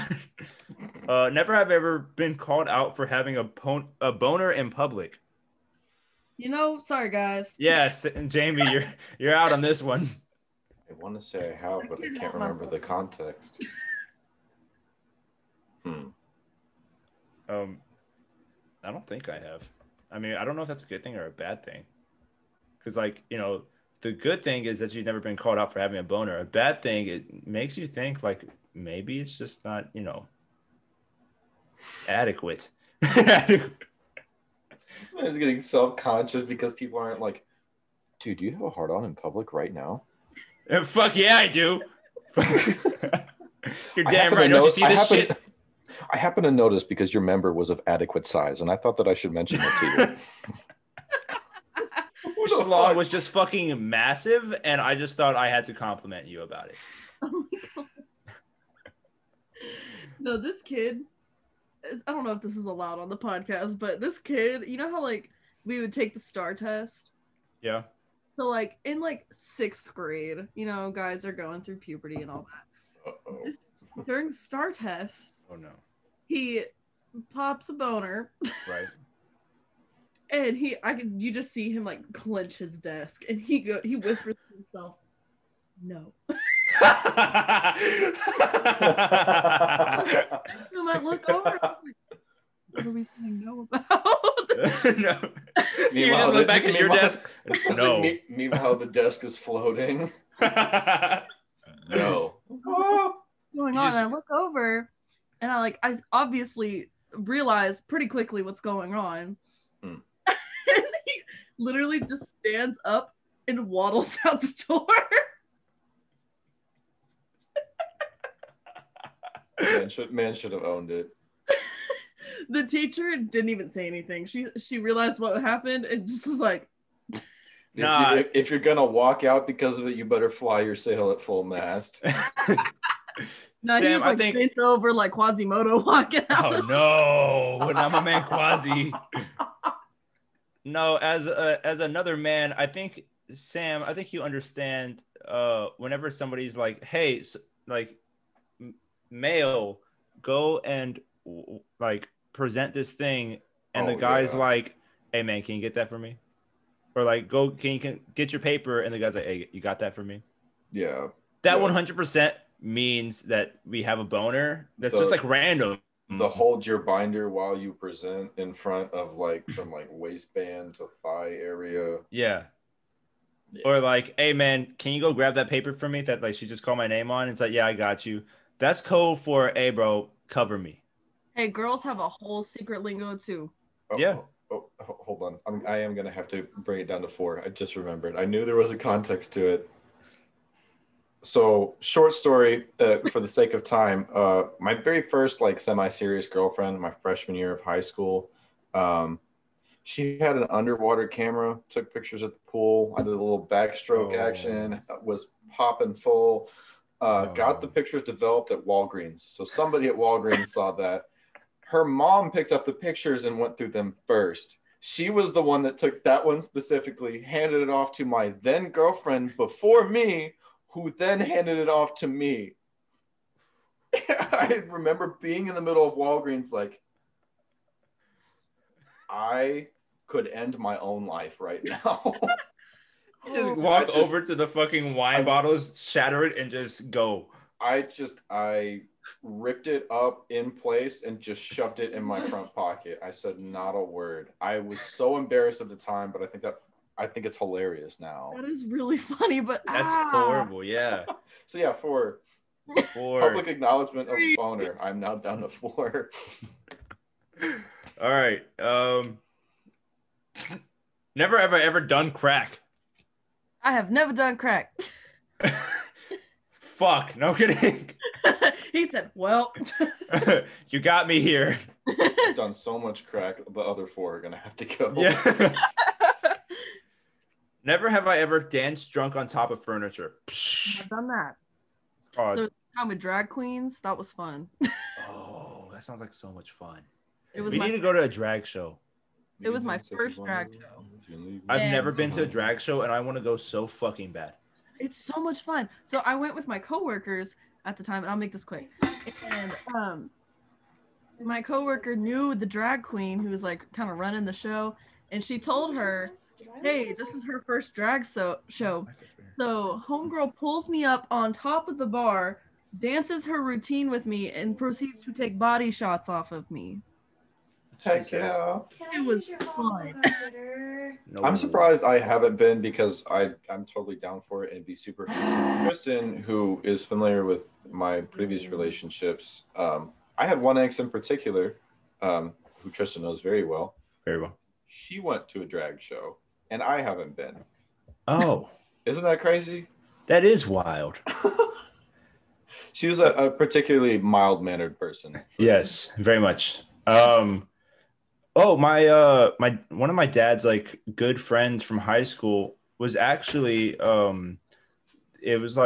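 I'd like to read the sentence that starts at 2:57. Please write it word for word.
It's like, yeah, I got you.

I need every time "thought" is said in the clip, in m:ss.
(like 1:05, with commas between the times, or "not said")
0:48, 0:55.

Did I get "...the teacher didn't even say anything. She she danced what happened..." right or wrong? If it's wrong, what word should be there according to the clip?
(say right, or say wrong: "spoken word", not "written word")
wrong: "realized", not "danced".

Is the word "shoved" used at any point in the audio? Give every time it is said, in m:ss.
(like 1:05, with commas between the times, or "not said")
4:01.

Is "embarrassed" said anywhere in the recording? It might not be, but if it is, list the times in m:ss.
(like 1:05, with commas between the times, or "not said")
4:05.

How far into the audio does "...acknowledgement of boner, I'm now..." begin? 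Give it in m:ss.
4:13.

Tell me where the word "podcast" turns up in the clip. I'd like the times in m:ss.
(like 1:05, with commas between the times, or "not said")
1:03.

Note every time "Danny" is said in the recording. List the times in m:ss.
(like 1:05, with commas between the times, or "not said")
not said.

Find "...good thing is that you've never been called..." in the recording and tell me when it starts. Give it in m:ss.
0:24.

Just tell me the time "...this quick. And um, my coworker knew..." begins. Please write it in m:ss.
4:58.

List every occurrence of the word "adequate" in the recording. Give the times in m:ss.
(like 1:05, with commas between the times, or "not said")
0:32, 0:47.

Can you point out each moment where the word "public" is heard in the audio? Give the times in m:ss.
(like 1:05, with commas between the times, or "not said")
0:04, 0:39, 4:13.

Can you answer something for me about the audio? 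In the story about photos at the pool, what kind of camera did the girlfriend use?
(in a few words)
underwater camera.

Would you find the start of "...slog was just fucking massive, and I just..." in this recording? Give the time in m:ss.
0:52.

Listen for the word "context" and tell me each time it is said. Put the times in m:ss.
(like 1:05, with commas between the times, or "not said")
0:12, 3:08.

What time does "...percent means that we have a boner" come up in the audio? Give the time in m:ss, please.
2:41.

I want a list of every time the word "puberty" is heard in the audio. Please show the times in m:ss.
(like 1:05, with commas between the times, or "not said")
1:11.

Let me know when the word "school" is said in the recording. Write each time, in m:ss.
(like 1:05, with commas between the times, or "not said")
3:17, 5:52.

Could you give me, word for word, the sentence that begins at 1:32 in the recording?
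What are we saying no about?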